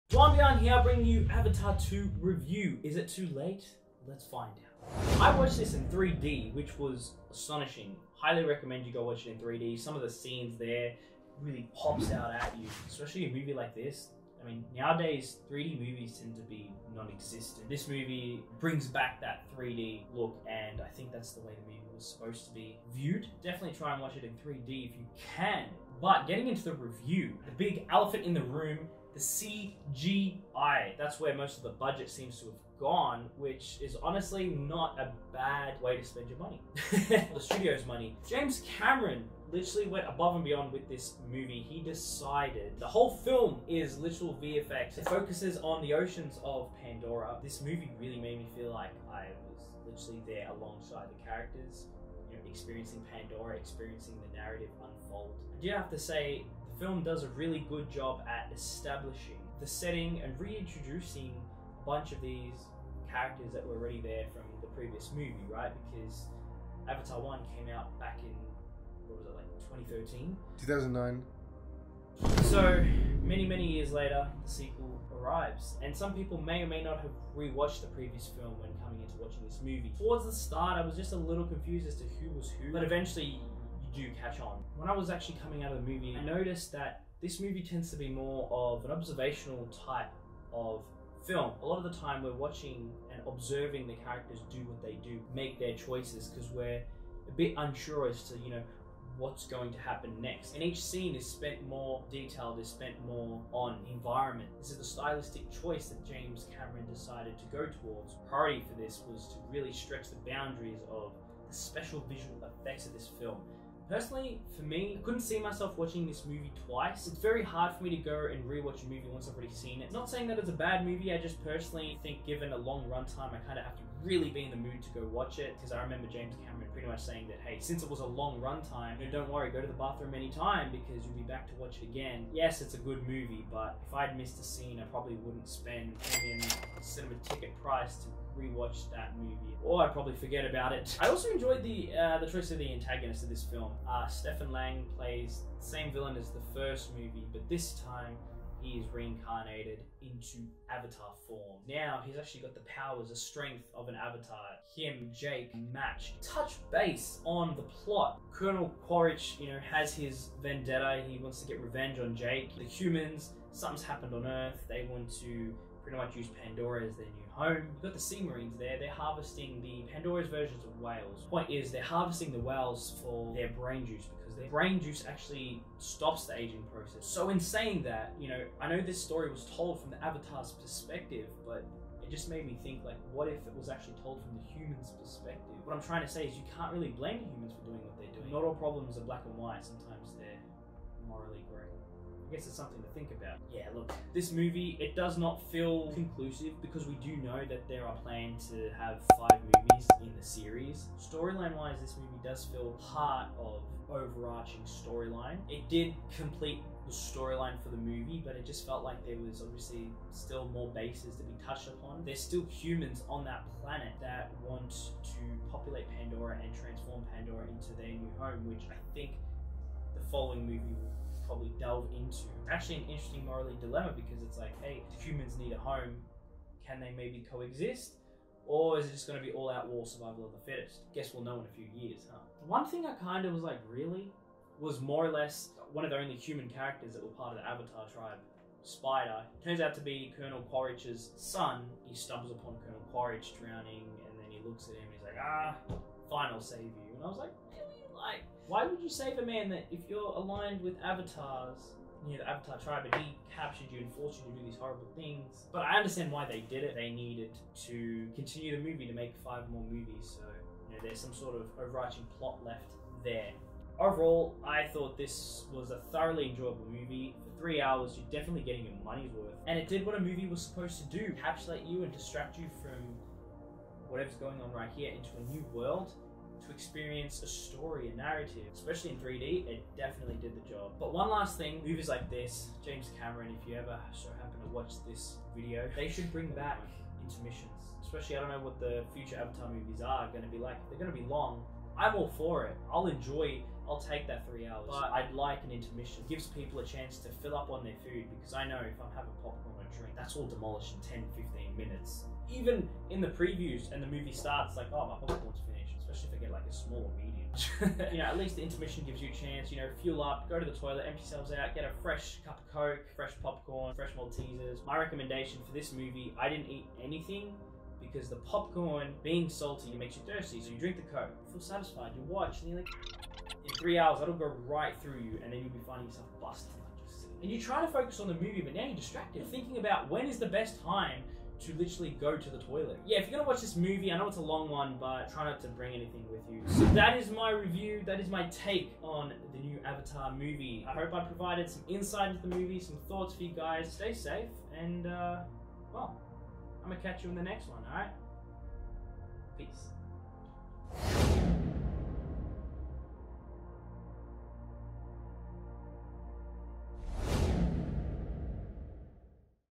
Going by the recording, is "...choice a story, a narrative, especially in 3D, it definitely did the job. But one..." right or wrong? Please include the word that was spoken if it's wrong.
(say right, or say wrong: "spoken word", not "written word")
wrong: "experience", not "choice".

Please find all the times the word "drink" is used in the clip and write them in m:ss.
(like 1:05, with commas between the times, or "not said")
4:59, 5:20.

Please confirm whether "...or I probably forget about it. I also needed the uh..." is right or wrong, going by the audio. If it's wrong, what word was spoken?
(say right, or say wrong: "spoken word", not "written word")
wrong: "enjoyed", not "needed".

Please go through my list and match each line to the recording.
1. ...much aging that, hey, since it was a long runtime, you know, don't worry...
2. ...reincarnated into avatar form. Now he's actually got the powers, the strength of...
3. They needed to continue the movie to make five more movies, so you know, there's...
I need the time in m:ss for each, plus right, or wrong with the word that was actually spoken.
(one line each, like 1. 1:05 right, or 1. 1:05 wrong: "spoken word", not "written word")
1. 2:06 wrong: "saying", not "aging"
2. 2:28 right
3. 4:16 right.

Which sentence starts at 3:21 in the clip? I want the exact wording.
Storyline wise, this movie does feel part of overarching storyline.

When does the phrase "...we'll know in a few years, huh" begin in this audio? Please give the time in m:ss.
3:51.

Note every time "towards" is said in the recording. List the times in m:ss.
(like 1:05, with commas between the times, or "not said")
1:19, 1:47.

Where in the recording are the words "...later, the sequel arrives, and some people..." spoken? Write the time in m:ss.
1:13.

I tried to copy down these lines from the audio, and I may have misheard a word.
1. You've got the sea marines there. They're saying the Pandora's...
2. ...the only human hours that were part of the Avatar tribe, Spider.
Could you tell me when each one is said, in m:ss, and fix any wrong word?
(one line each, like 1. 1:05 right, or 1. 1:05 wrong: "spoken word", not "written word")
1. 2:47 wrong: "harvesting", not "saying"
2. 3:55 wrong: "characters", not "hours".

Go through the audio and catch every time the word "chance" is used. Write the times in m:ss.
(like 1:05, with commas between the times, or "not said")
4:56, 5:09.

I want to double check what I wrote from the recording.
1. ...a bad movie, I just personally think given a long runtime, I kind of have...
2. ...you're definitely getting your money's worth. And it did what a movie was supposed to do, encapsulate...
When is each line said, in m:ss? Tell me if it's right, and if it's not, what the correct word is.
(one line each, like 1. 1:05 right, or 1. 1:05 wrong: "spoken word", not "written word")
1. 2:00 right
2. 4:27 right.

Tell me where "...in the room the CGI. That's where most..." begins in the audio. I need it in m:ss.
0:28.